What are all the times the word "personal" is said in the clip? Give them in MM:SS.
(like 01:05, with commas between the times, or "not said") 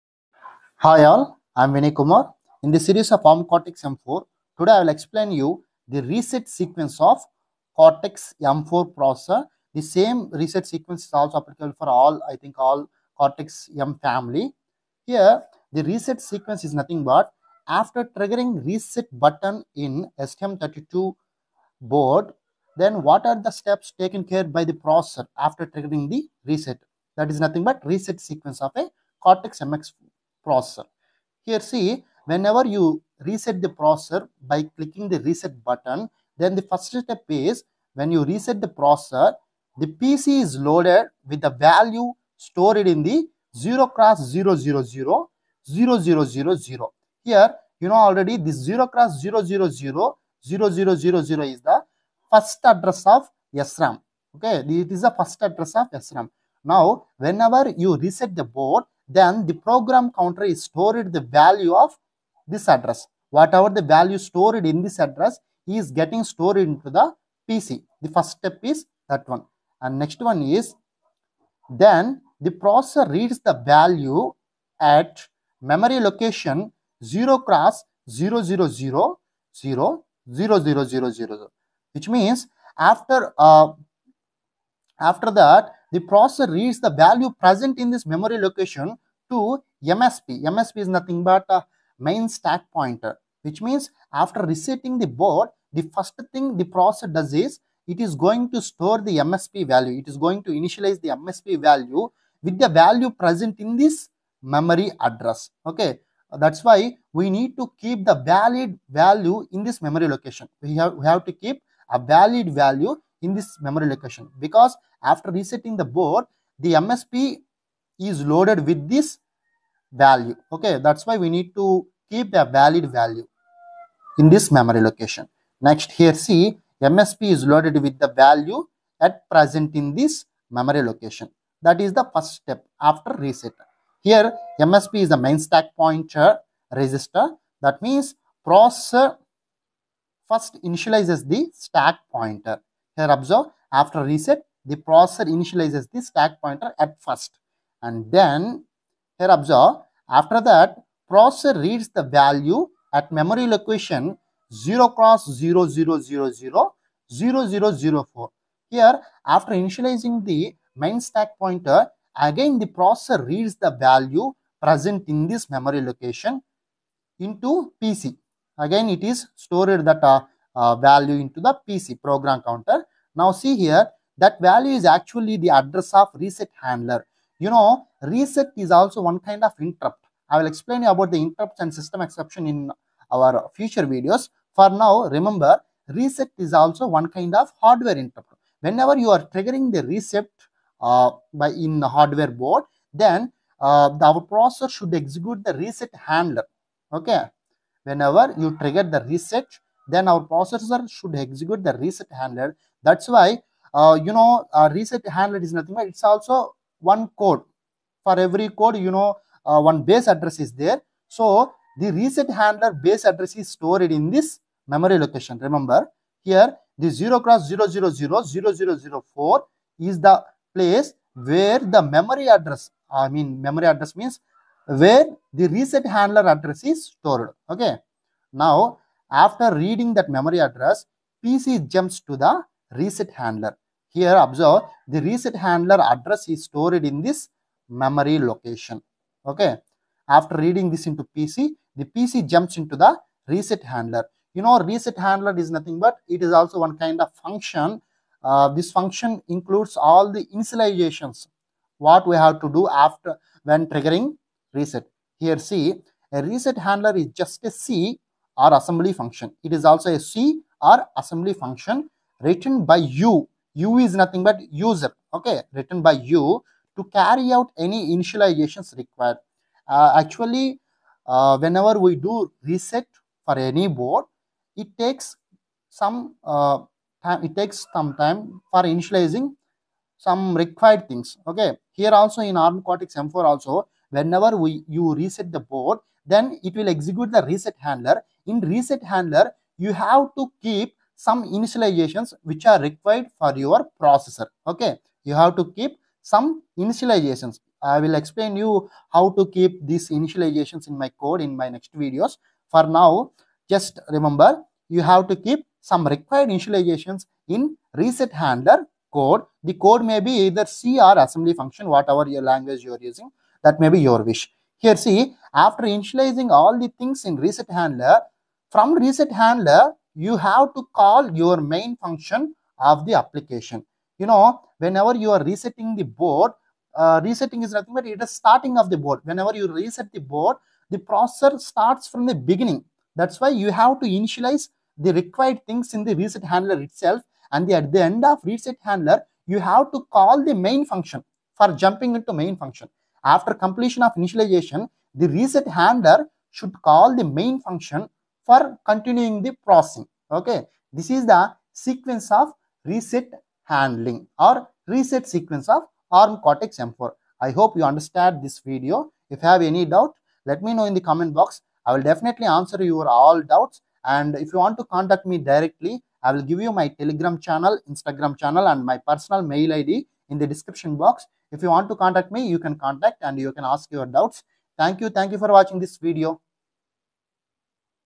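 06:08.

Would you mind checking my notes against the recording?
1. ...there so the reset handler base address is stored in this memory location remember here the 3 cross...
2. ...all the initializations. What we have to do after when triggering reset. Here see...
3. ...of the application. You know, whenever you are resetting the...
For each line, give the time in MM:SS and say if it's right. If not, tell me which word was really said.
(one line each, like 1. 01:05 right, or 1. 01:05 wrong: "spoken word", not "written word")
1. 03:30 wrong: "0", not "3"
2. 04:09 right
3. 05:22 right.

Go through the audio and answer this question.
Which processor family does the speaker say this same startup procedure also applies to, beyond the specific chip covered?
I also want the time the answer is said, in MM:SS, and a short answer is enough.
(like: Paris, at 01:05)
Cortex M family, at 00:13.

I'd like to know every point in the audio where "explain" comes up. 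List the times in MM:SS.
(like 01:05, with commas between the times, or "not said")
00:04, 03:00, 04:58.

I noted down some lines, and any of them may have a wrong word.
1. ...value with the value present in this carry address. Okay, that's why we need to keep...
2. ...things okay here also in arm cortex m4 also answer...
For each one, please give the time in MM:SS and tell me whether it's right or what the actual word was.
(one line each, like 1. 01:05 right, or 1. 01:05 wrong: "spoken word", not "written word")
1. 01:41 wrong: "memory", not "carry"
2. 04:40 wrong: "whenever", not "answer".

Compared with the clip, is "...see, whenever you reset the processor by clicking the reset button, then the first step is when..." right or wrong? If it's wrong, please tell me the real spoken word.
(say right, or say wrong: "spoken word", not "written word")
right.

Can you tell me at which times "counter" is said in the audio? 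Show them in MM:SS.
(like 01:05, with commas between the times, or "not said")
01:00, 02:52.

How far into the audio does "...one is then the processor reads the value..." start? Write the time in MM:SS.
01:10.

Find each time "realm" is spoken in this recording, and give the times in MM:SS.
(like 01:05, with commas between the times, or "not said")
not said.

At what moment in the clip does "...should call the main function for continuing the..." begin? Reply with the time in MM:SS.
05:46.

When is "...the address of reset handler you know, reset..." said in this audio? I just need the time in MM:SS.
02:55.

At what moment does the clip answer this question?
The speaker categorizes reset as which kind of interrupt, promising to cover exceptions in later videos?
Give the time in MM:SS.
03:07.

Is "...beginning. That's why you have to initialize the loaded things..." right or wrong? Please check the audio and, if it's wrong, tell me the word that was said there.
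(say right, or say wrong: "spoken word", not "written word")
wrong: "required", not "loaded".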